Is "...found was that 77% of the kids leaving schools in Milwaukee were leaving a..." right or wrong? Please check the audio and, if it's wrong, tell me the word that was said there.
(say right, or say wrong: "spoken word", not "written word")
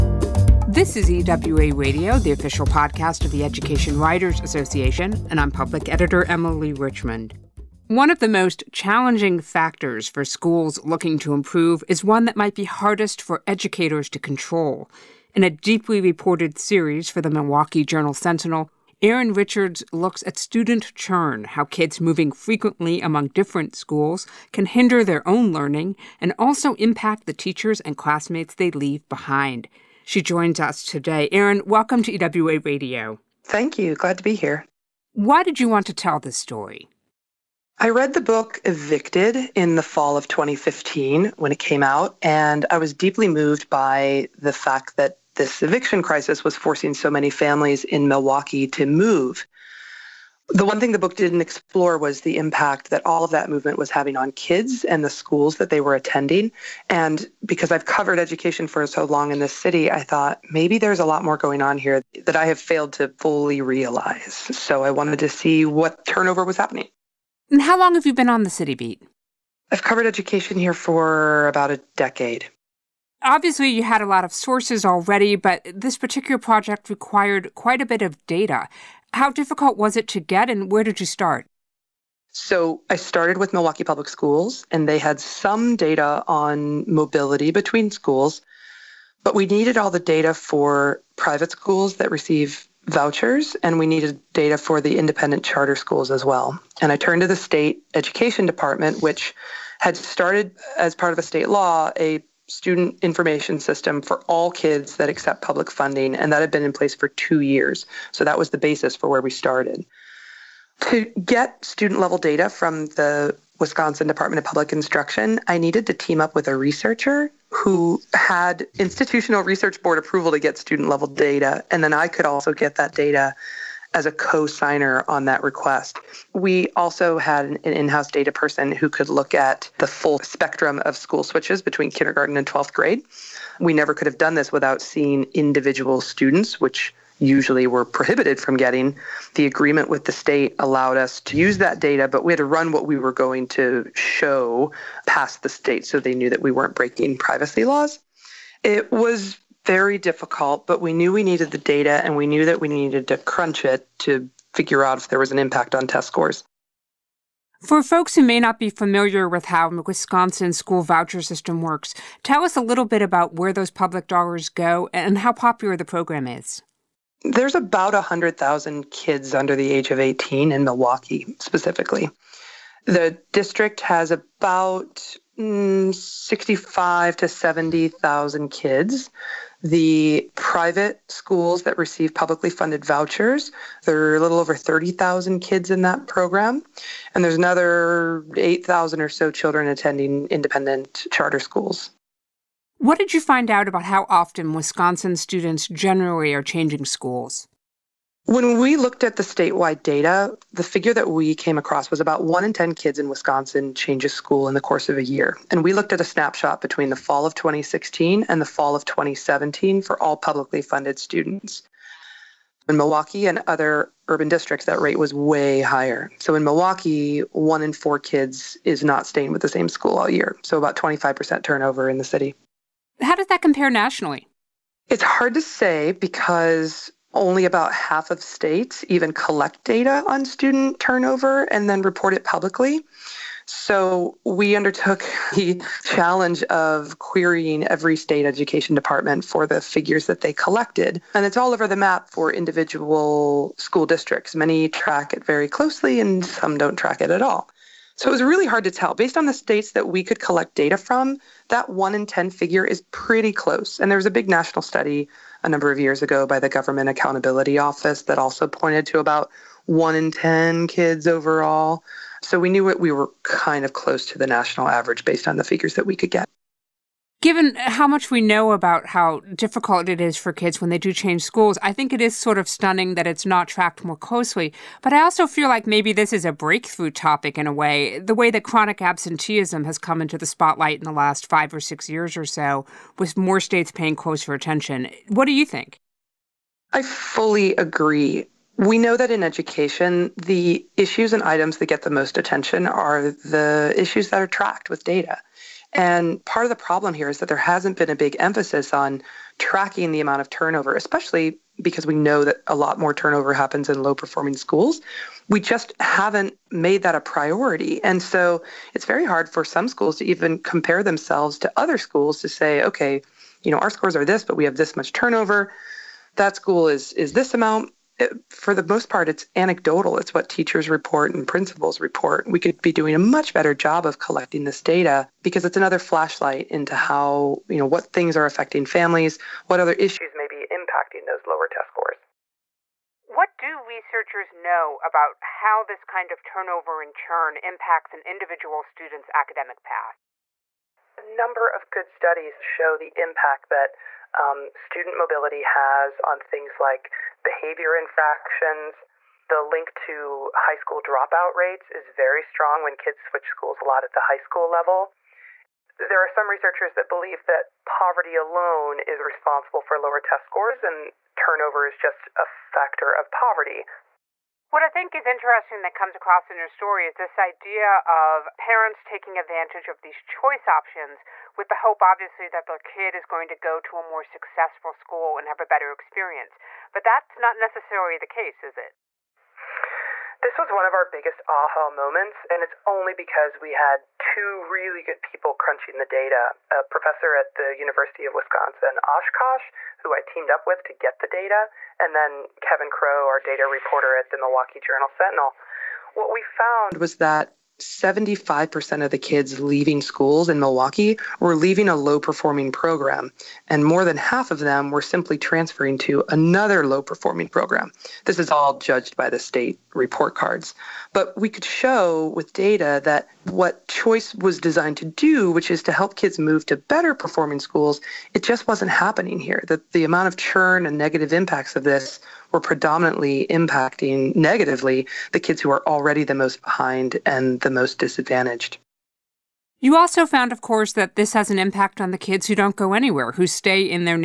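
wrong: "75", not "77".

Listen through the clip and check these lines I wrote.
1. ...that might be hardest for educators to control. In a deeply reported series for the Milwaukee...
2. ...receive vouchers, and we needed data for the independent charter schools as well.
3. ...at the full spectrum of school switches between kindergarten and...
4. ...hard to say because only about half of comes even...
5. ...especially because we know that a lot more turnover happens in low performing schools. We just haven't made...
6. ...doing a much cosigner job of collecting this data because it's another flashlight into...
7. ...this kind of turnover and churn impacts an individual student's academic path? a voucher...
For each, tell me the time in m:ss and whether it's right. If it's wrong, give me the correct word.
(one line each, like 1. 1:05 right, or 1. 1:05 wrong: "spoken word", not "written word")
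1. 0:12 right
2. 1:32 right
3. 2:09 right
4. 3:45 wrong: "states", not "comes"
5. 5:00 right
6. 5:22 wrong: "better", not "cosigner"
7. 5:35 wrong: "number", not "voucher".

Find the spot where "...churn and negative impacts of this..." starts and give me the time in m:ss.
7:00.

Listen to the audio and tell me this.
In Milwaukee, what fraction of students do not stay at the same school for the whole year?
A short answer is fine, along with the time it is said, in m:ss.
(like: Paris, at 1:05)
1 in 4, at 3:37.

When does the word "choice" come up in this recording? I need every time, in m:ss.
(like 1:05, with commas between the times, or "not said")
6:10, 6:53.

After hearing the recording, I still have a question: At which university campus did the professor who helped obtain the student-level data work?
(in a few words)
University of Wisconsin Oshkosh.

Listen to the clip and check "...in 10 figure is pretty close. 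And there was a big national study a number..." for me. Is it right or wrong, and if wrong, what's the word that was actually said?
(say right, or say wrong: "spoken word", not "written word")
right.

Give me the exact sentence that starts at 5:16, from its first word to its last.
That school is is this amount for the most part, it's anecdotal.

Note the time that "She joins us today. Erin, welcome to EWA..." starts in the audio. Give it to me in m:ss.
0:30.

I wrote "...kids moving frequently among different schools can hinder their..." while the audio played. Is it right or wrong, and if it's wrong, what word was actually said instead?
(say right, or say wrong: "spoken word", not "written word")
right.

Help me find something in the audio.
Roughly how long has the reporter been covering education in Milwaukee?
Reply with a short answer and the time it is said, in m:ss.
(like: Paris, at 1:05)
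about a decade, at 1:11.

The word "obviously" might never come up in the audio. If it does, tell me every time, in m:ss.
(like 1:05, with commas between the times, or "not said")
1:13, 6:11.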